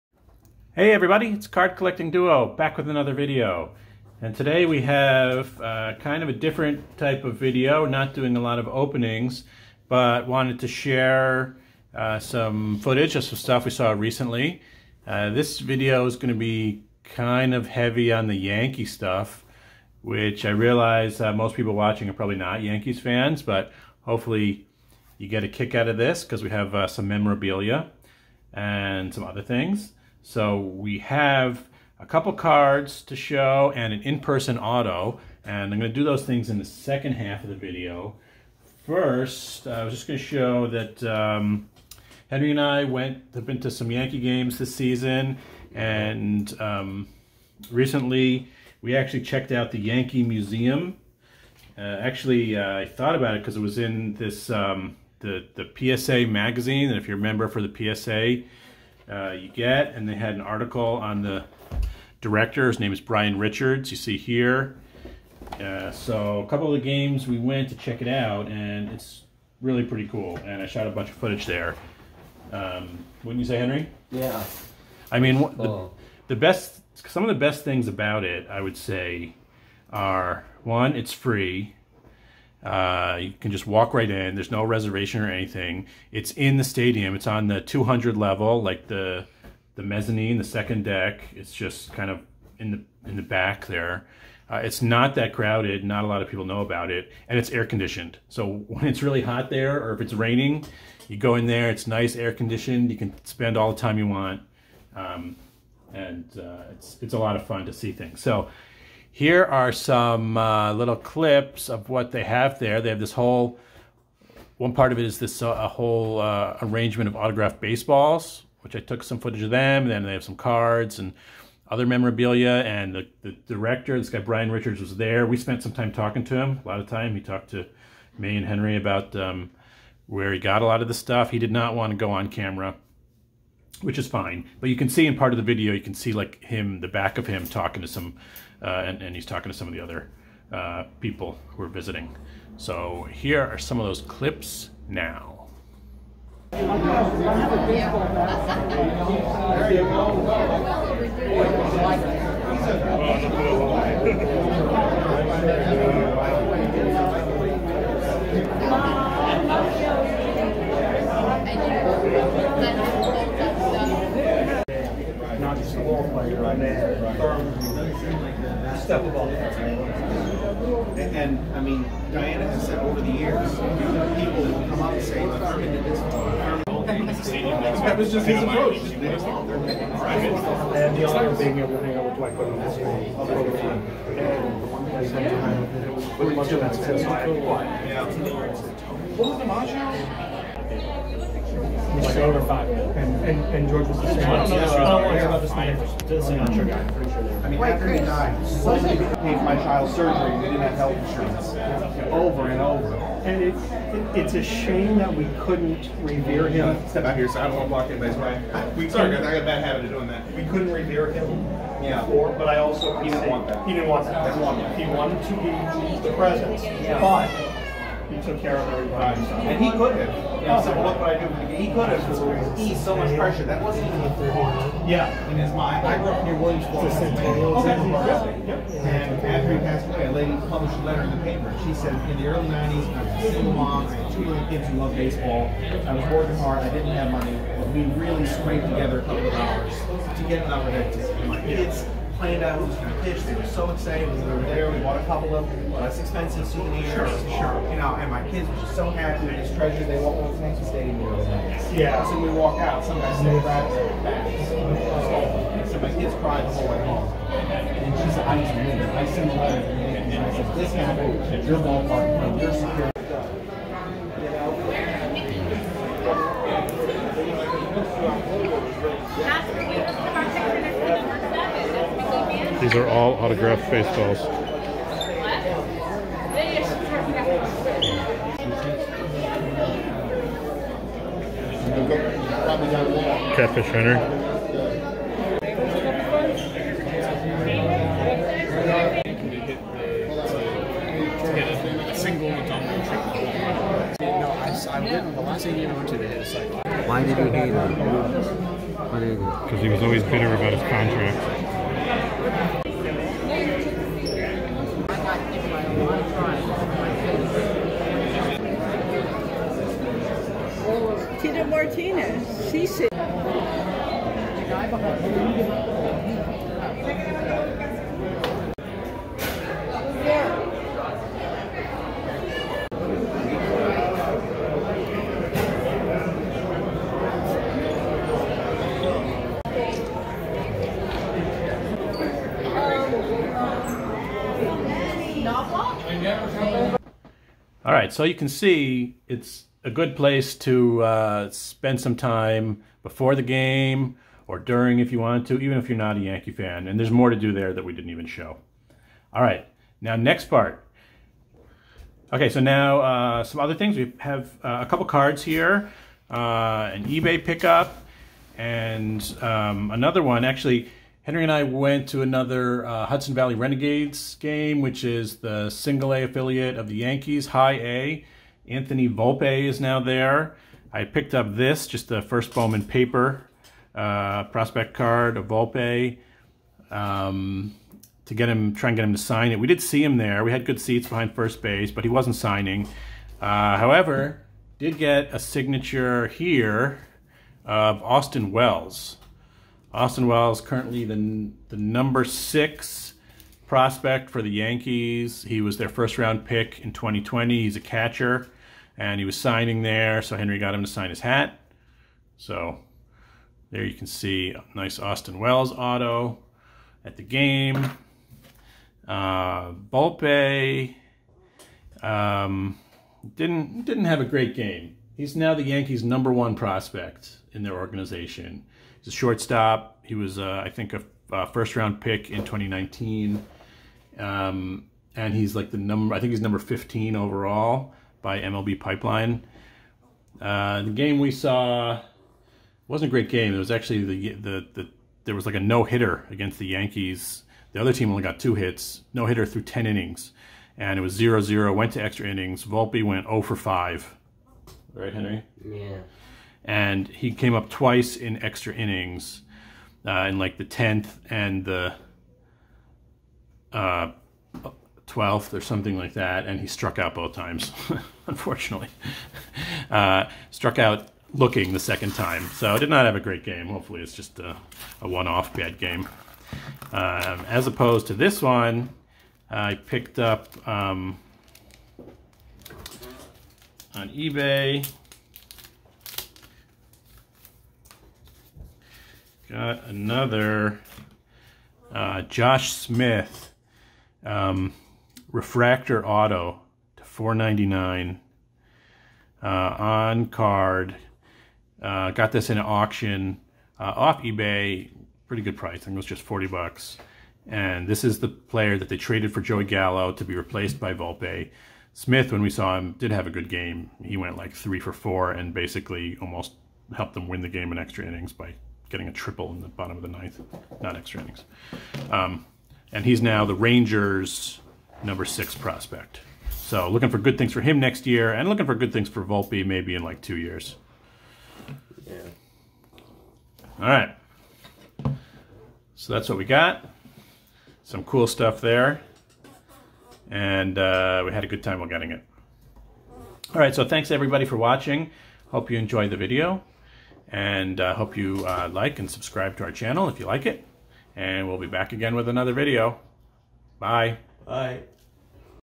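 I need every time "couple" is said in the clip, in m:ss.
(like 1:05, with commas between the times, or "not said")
0:32, 1:06, 3:59, 4:05, 5:54.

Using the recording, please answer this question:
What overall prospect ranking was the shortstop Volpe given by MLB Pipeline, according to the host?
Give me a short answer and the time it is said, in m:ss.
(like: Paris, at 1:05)
15, at 7:06.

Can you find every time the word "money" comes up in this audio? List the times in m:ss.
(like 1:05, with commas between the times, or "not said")
3:57.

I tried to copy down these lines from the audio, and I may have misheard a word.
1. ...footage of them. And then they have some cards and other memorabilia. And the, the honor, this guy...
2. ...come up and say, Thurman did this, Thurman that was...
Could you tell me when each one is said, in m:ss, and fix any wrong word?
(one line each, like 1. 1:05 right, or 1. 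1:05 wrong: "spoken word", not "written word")
1. 1:59 wrong: "director", not "honor"
2. 2:54 right.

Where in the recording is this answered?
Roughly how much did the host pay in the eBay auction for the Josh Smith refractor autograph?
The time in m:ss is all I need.
8:16.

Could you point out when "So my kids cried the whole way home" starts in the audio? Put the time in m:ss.
4:15.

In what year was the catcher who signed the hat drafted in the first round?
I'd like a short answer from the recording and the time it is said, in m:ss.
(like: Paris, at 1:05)
2020, at 6:36.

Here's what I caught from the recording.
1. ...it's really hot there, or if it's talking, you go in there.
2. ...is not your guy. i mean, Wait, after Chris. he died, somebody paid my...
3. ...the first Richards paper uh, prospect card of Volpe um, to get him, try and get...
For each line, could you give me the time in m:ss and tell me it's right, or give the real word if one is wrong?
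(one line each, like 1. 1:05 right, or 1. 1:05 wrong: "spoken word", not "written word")
1. 1:38 wrong: "raining", not "talking"
2. 3:16 right
3. 6:11 wrong: "Bowman", not "Richards".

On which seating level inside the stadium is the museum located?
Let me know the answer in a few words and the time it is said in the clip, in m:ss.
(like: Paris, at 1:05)
200 level, at 1:27.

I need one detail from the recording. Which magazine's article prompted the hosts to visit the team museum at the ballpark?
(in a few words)
PSA magazine.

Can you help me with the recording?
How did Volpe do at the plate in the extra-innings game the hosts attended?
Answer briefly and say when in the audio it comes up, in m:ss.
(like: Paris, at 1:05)
0 for 5, at 7:23.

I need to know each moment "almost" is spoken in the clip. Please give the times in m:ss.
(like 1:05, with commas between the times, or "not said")
8:26.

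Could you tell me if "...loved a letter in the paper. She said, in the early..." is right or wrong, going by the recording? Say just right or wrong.
wrong.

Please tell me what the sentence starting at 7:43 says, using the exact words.
Hopefully, it's just a, a one off bad game.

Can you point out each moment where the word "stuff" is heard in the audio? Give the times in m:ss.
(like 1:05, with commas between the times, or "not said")
0:13, 0:18, 2:10, 8:48.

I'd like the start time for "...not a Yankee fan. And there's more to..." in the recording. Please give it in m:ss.
5:45.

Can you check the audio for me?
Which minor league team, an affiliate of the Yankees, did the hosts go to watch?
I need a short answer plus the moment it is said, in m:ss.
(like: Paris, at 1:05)
Hudson Valley Renegades, at 6:02.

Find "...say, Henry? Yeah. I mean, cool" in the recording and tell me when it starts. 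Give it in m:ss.
1:13.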